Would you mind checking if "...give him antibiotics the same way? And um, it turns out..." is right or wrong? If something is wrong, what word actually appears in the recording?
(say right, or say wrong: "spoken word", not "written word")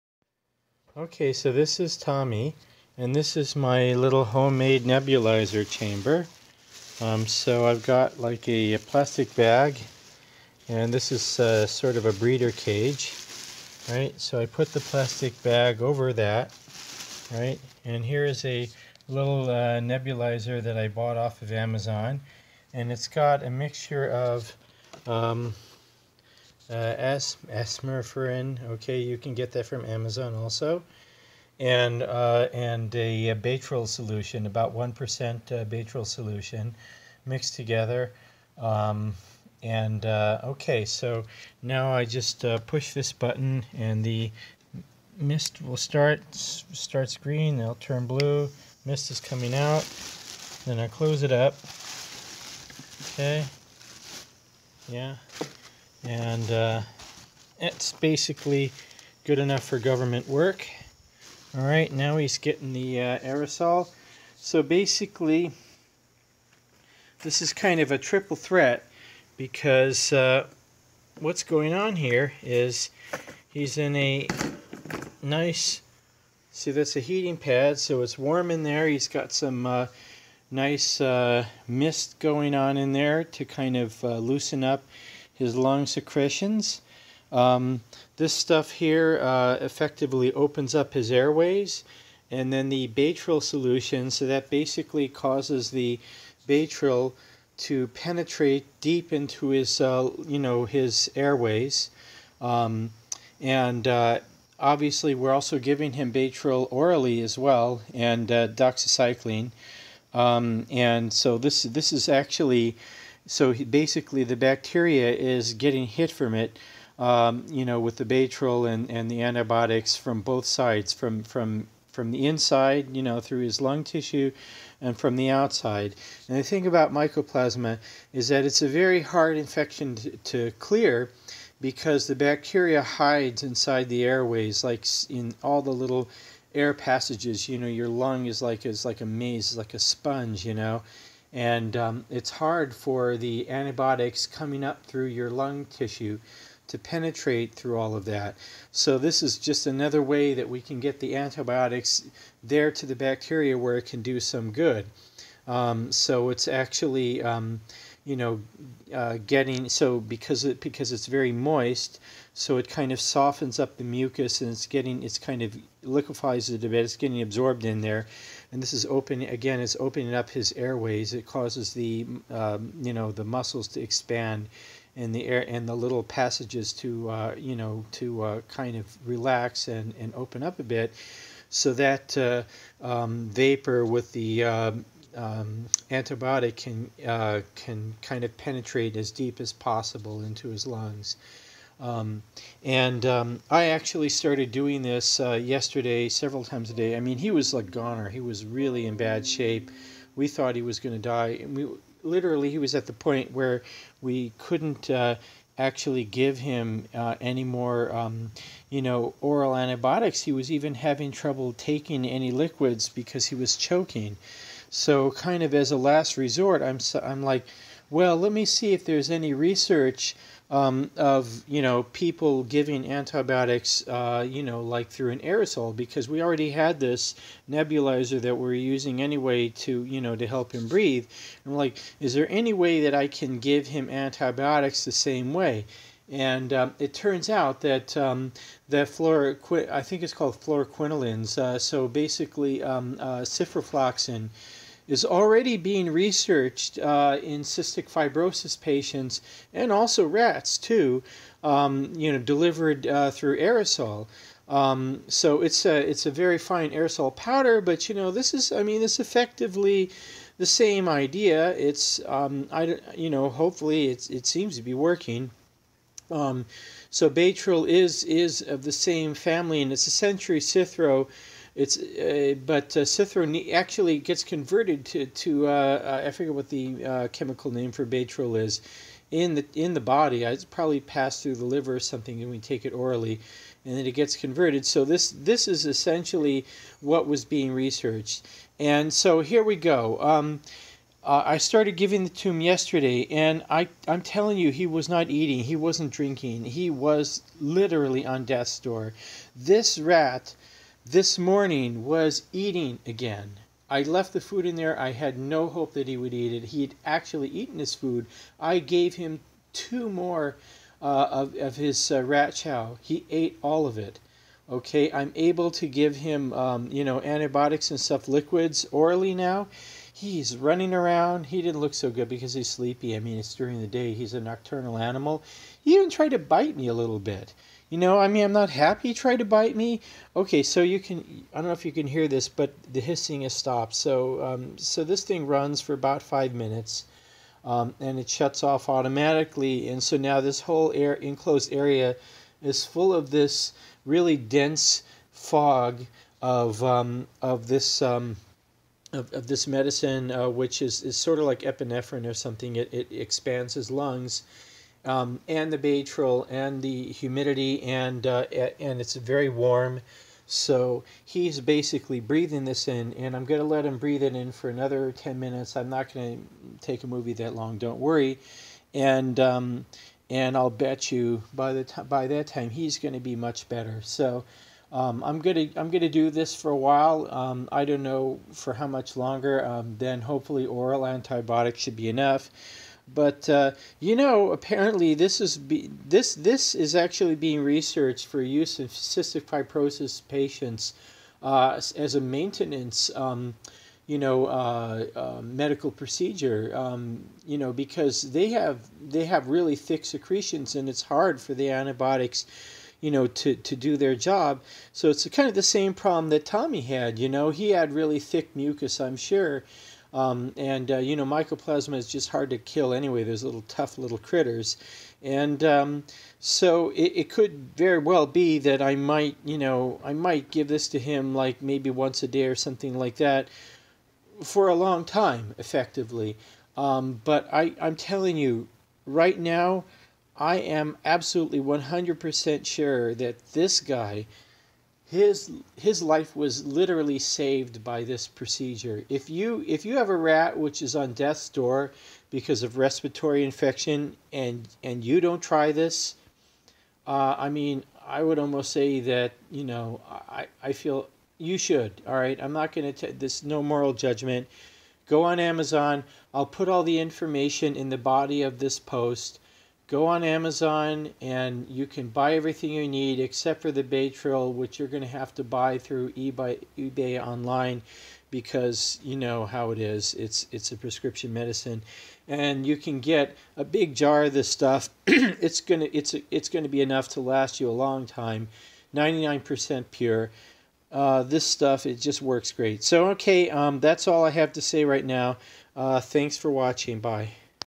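right.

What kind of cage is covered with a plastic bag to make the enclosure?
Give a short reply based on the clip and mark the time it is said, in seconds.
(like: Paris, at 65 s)
breeder cage, at 12 s.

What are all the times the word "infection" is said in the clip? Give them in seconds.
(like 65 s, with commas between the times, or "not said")
129 s, 443 s.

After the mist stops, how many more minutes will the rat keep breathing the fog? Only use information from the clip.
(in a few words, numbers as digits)
10.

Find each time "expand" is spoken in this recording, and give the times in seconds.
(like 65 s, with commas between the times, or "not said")
173 s, 352 s.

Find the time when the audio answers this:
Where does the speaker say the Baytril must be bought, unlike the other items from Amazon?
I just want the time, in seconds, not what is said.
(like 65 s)
466 s.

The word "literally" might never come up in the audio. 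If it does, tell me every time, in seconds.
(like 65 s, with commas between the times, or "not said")
202 s, 297 s, 436 s.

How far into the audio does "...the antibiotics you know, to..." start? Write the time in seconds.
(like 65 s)
401 s.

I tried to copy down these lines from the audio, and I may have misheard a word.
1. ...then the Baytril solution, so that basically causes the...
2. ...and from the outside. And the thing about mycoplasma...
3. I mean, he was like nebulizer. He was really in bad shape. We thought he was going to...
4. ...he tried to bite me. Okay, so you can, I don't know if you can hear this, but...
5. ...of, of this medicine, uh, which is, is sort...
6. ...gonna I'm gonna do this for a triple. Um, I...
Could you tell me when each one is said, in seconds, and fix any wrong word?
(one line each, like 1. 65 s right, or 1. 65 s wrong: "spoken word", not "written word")
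1. 92 s right
2. 124 s right
3. 196 s wrong: "goner", not "nebulizer"
4. 328 s right
5. 348 s right
6. 375 s wrong: "while", not "triple".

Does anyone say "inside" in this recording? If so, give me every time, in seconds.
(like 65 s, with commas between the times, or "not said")
122 s, 133 s.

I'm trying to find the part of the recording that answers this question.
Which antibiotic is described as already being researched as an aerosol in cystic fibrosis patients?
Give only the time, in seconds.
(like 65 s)
243 s.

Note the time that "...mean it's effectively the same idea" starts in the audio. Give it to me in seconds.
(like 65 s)
258 s.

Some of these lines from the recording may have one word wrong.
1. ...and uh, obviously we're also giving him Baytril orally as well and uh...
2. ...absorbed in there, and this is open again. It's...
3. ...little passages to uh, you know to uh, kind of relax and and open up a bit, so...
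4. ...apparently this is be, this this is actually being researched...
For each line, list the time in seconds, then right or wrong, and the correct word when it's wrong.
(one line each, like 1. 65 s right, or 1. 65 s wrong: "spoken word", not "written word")
1. 103 s right
2. 167 s right
3. 175 s right
4. 384 s right.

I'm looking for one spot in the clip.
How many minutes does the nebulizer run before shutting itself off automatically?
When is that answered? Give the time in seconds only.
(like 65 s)
336 s.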